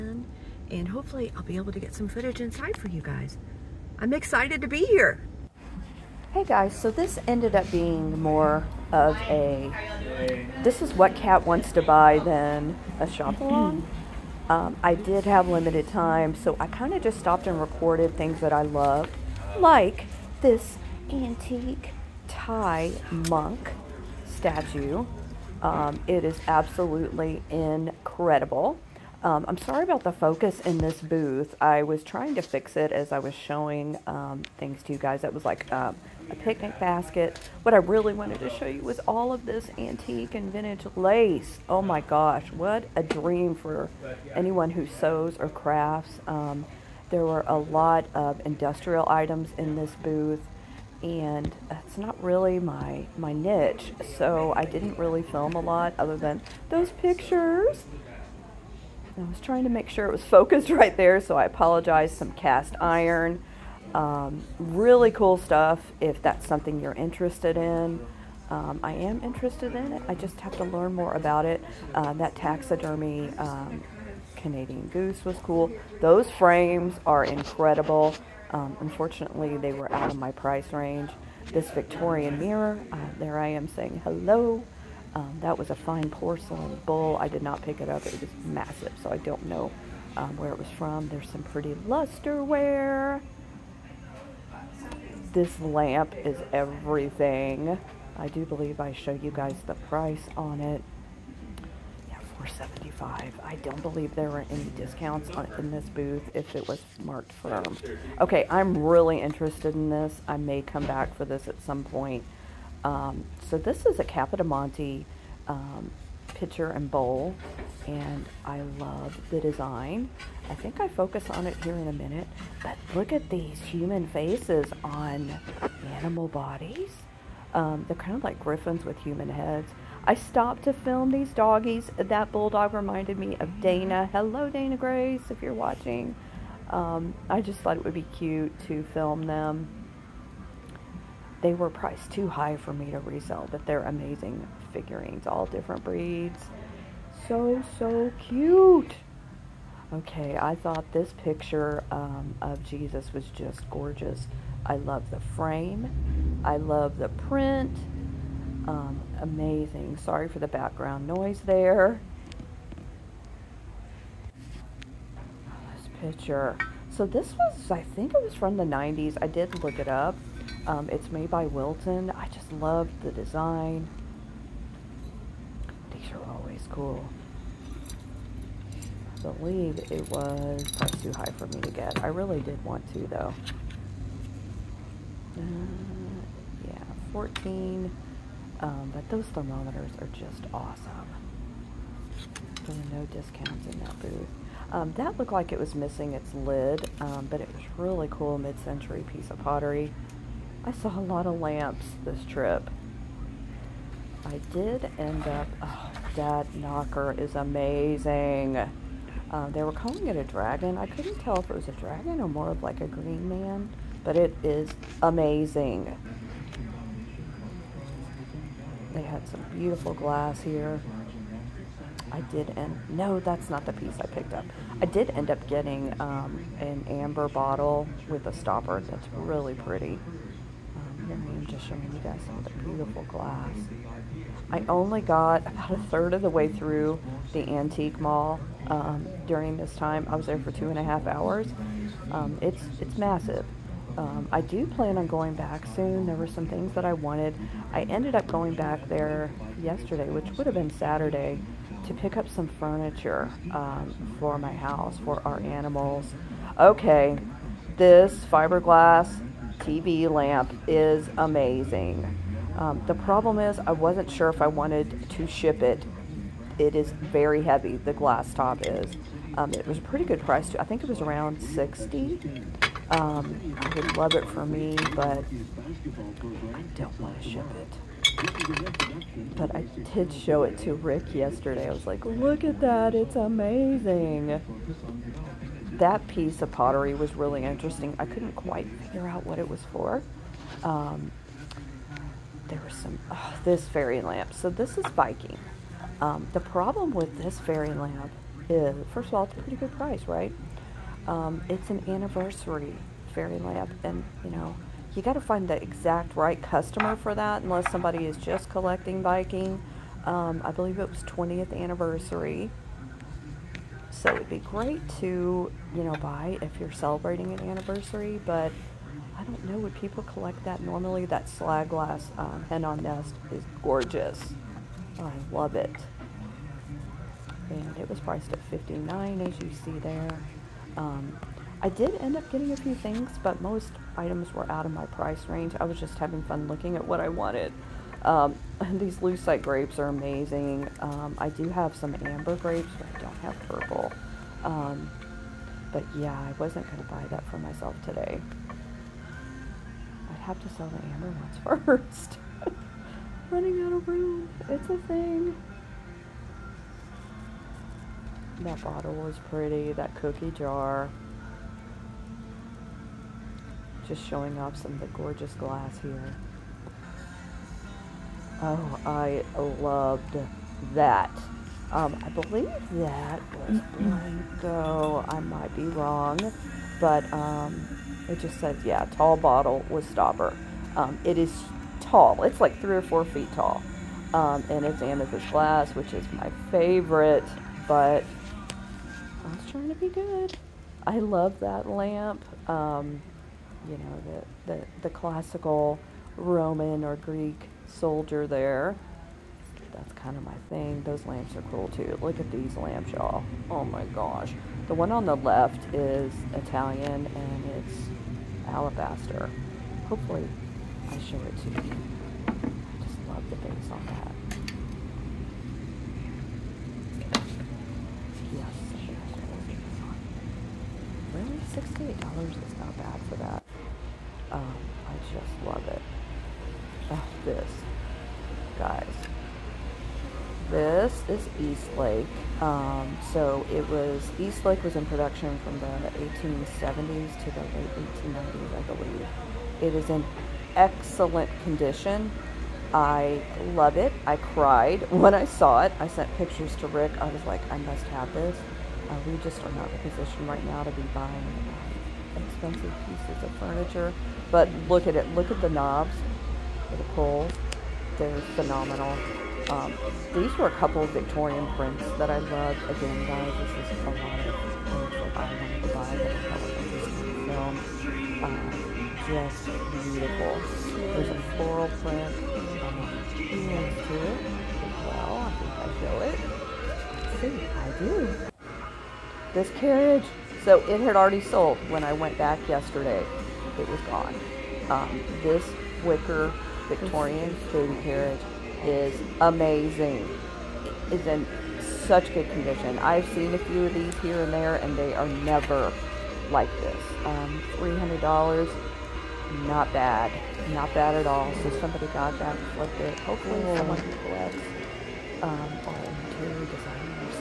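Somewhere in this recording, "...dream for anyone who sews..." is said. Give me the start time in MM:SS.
00:43.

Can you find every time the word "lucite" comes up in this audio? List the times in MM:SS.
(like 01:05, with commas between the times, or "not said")
05:38.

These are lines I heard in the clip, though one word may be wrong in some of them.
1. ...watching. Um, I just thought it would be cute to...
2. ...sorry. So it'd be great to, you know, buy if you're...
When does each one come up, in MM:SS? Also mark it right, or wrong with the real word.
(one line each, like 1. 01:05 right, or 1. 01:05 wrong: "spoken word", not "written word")
1. 02:15 right
2. 05:11 wrong: "anniversary", not "sorry".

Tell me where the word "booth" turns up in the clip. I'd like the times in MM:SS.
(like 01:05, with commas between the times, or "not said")
00:31, 00:50, 01:45, 03:14.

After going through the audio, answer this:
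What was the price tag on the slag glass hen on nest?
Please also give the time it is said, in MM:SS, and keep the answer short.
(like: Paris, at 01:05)
59, at 05:28.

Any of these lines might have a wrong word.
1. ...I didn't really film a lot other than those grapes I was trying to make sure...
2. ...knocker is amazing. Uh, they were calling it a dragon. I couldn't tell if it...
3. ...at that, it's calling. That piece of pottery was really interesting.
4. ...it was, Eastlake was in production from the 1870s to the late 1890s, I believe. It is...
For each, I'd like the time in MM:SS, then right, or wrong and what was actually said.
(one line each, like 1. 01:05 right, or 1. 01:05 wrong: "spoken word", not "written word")
1. 00:54 wrong: "pictures", not "grapes"
2. 03:26 right
3. 04:42 wrong: "amazing", not "calling"
4. 07:13 right.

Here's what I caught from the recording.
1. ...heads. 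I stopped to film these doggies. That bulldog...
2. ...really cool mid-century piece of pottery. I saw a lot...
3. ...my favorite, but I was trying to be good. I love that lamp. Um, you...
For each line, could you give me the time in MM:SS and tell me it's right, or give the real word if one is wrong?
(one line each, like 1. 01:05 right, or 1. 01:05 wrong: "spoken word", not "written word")
1. 02:09 right
2. 03:17 right
3. 06:26 right.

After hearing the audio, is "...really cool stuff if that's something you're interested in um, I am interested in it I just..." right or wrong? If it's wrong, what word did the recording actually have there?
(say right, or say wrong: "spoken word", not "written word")
right.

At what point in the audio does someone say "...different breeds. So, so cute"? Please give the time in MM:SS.
02:25.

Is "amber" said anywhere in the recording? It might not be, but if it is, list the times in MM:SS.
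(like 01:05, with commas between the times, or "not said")
03:46, 05:42, 05:50.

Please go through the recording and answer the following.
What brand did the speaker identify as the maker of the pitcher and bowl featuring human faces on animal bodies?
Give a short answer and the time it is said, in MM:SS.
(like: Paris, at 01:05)
Capodimonte, at 01:54.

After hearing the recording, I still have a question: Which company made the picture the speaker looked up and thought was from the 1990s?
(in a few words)
Wilton.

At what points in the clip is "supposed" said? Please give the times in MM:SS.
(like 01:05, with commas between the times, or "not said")
not said.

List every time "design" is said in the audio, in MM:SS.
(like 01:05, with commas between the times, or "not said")
01:59, 02:53, 08:26.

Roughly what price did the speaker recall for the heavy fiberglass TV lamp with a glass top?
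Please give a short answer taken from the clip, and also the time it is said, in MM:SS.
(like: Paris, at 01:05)
60, at 04:31.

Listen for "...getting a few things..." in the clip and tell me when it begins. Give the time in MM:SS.
05:32.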